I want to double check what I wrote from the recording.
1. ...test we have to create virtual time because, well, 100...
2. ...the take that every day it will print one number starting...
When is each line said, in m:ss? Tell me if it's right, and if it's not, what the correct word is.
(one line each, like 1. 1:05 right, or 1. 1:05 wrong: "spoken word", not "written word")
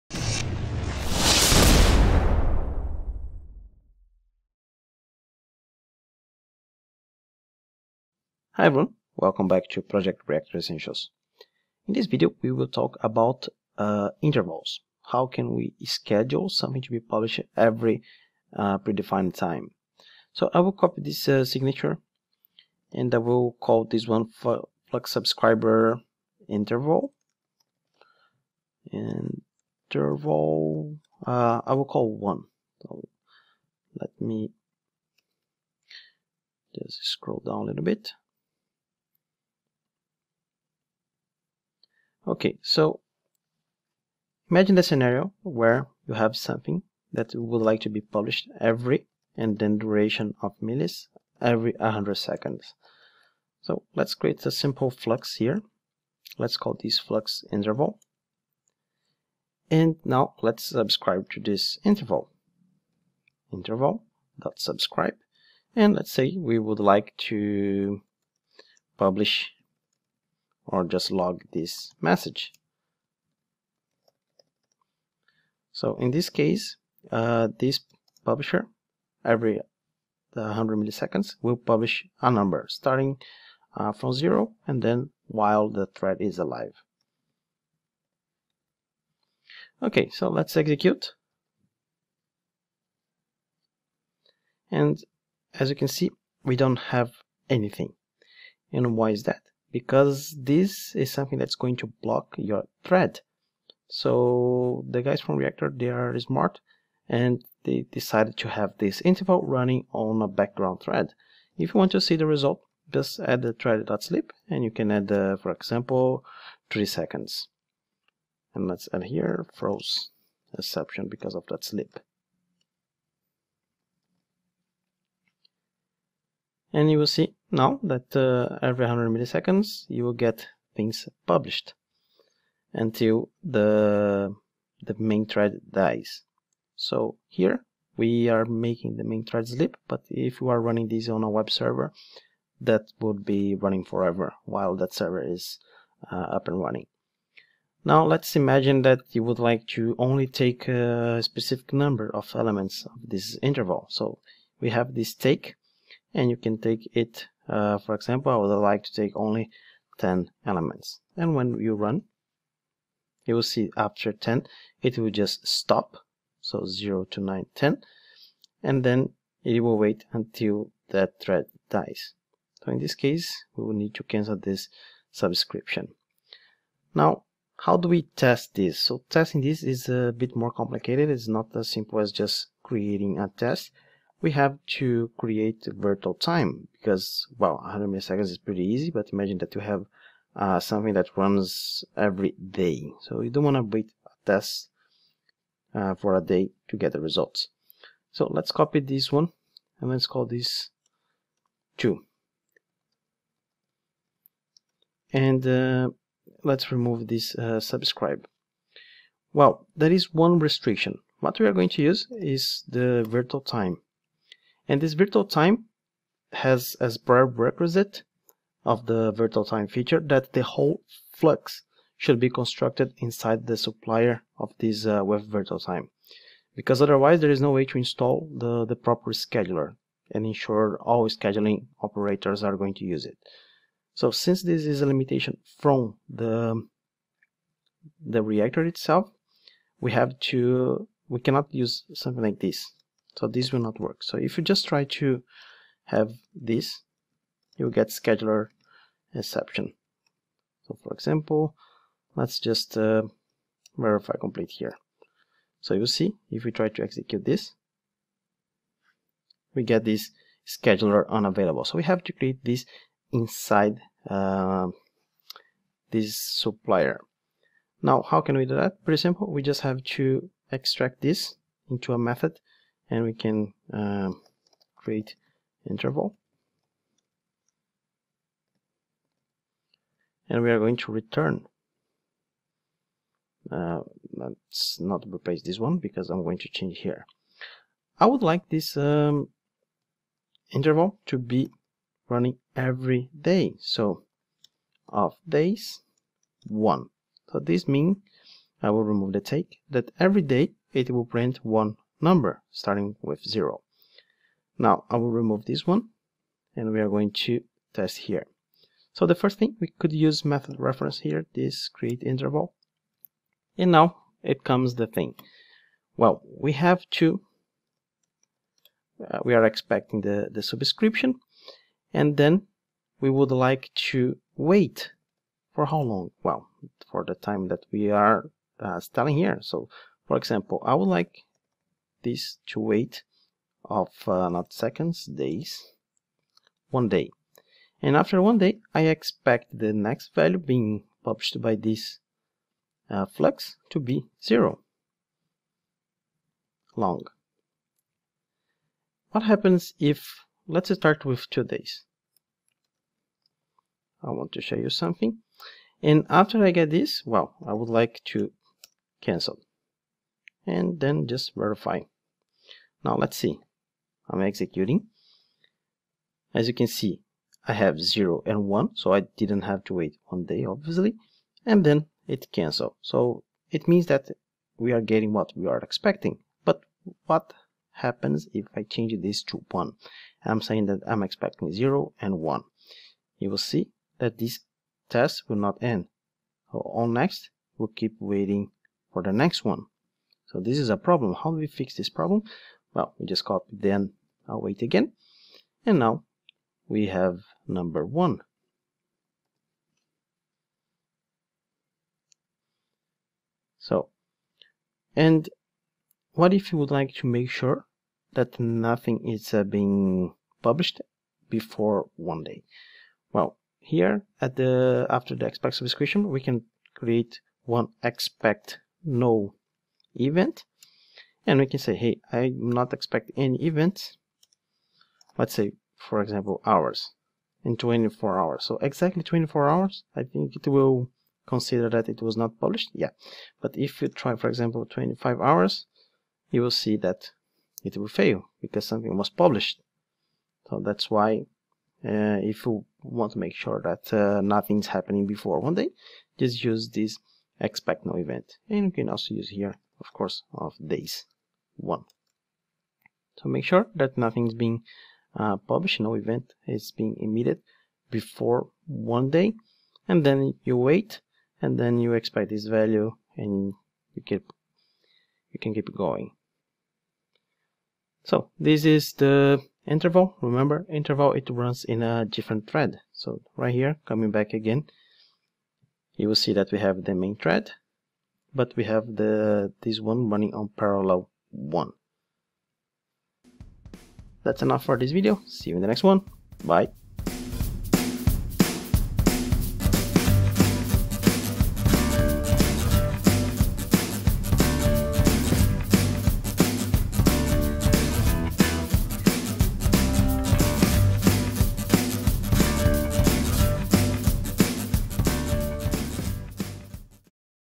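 1. 3:03 right
2. 4:59 right.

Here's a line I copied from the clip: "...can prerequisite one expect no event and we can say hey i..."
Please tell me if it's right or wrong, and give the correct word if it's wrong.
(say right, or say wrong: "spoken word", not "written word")
wrong: "create", not "prerequisite".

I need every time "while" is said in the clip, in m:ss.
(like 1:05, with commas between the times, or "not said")
1:25, 2:24.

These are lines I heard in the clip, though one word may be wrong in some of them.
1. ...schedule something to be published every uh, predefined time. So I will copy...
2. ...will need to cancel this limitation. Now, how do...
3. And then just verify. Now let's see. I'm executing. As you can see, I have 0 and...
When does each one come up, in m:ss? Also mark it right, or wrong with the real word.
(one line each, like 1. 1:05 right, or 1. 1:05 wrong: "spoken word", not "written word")
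1. 0:15 right
2. 2:53 wrong: "subscription", not "limitation"
3. 6:00 right.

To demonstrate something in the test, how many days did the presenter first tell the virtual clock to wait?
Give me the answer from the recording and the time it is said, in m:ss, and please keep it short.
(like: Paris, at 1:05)
2 days, at 5:51.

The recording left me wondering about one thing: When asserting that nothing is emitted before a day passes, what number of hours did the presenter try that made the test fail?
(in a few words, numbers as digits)
25.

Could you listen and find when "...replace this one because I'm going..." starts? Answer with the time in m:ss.
4:45.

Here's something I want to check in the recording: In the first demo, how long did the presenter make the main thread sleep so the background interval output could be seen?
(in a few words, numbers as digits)
3 seconds.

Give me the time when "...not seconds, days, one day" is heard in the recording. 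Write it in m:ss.
5:34.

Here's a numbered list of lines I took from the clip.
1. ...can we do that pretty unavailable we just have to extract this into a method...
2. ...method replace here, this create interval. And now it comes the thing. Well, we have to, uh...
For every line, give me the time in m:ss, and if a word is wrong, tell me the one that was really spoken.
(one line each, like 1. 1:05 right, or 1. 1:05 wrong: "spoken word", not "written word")
1. 4:28 wrong: "simple", not "unavailable"
2. 5:10 wrong: "reference", not "replace".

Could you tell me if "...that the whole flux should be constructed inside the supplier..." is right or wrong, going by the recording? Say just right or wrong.
right.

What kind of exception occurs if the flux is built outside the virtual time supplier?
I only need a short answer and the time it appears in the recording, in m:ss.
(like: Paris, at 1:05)
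scheduler exception, at 4:07.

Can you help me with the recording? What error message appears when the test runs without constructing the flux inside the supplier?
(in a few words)
scheduler unavailable.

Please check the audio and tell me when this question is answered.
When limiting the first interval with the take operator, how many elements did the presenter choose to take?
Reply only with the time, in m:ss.
2:39.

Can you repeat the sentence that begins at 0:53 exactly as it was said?
So let's create a simple flux here.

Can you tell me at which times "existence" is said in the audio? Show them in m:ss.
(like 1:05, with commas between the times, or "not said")
not said.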